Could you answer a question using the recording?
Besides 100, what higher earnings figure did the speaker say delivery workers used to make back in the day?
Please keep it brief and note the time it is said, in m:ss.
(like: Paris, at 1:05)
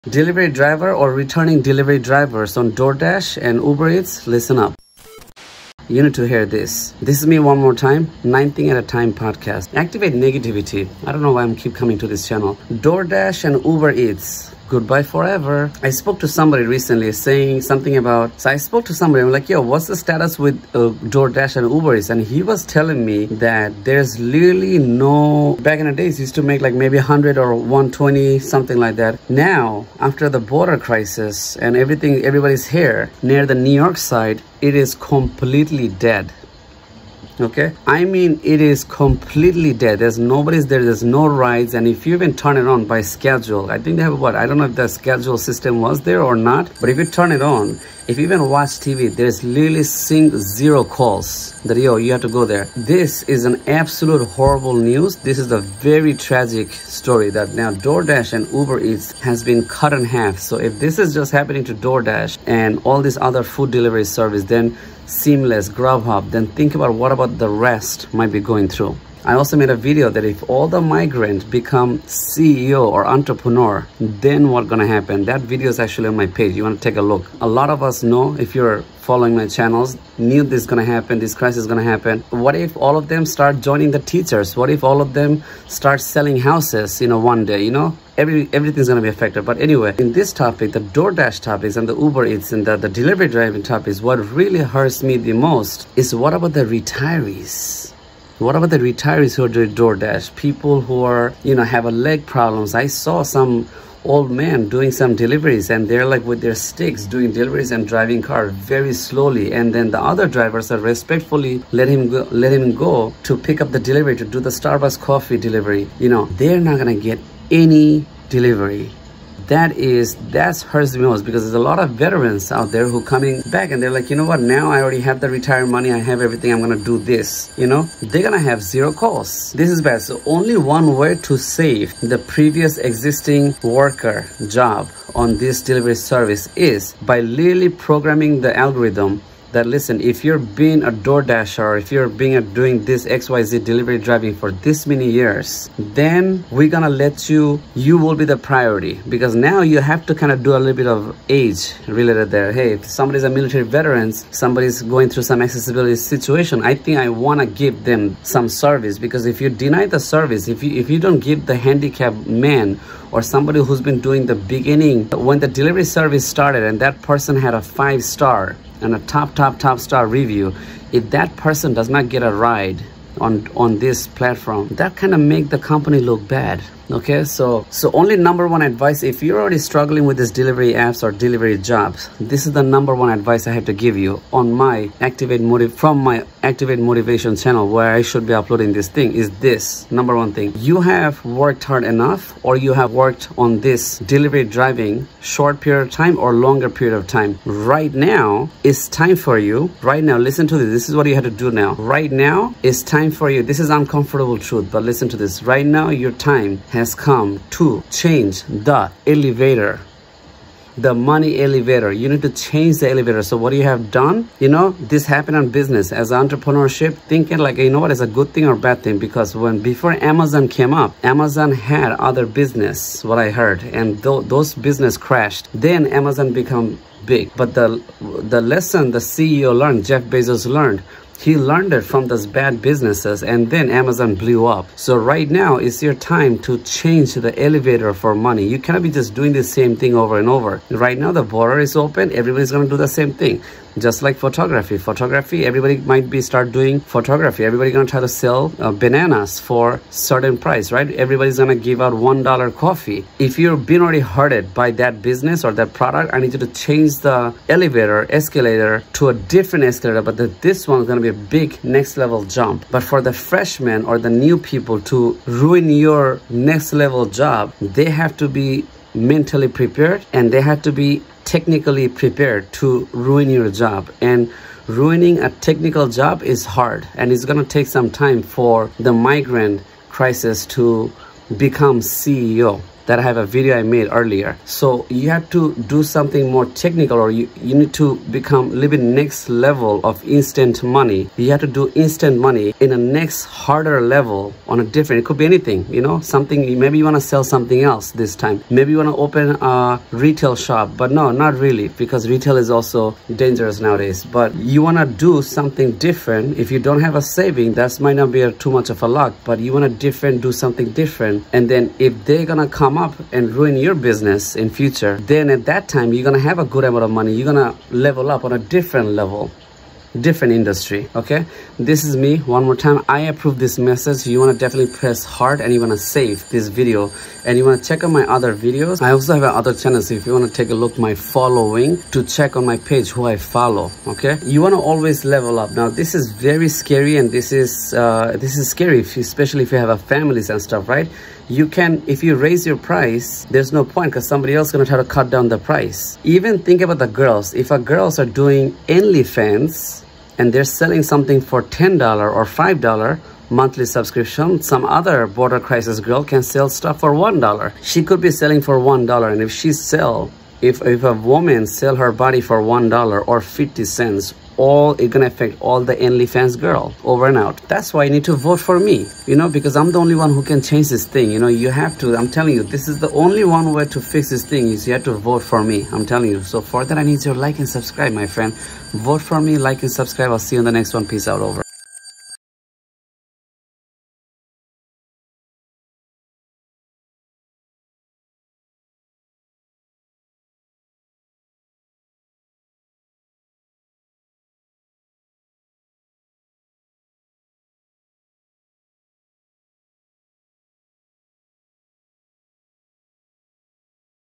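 120, at 0:27.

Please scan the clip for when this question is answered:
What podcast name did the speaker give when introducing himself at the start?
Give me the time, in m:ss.
0:08.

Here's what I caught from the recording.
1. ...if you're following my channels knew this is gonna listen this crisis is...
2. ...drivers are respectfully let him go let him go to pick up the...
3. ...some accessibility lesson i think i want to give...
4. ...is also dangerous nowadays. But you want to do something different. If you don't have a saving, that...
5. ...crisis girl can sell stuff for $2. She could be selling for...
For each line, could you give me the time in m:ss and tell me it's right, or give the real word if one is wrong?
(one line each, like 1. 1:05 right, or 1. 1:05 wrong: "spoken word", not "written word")
1. 1:18 wrong: "happen", not "listen"
2. 1:50 right
3. 2:35 wrong: "situation", not "lesson"
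4. 5:02 right
5. 5:55 wrong: "1", not "2".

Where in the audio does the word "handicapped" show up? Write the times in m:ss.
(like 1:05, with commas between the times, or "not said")
2:41.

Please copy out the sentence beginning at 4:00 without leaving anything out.
Right now the border is open.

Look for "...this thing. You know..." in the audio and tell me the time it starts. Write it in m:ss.
6:10.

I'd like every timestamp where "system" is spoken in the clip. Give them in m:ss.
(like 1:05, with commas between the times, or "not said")
0:45.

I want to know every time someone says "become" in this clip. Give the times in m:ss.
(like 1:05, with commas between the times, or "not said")
1:11, 3:46, 4:41, 4:48.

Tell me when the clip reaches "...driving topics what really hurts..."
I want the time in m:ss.
1:33.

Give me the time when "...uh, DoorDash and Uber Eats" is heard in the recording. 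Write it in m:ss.
0:20.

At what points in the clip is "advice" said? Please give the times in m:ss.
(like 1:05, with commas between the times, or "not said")
2:58, 3:03.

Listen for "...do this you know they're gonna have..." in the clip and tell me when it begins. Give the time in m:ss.
2:06.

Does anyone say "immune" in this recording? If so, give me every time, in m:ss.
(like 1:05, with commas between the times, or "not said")
not said.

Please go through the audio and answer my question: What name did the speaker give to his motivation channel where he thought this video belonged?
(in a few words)
Activate Motivation.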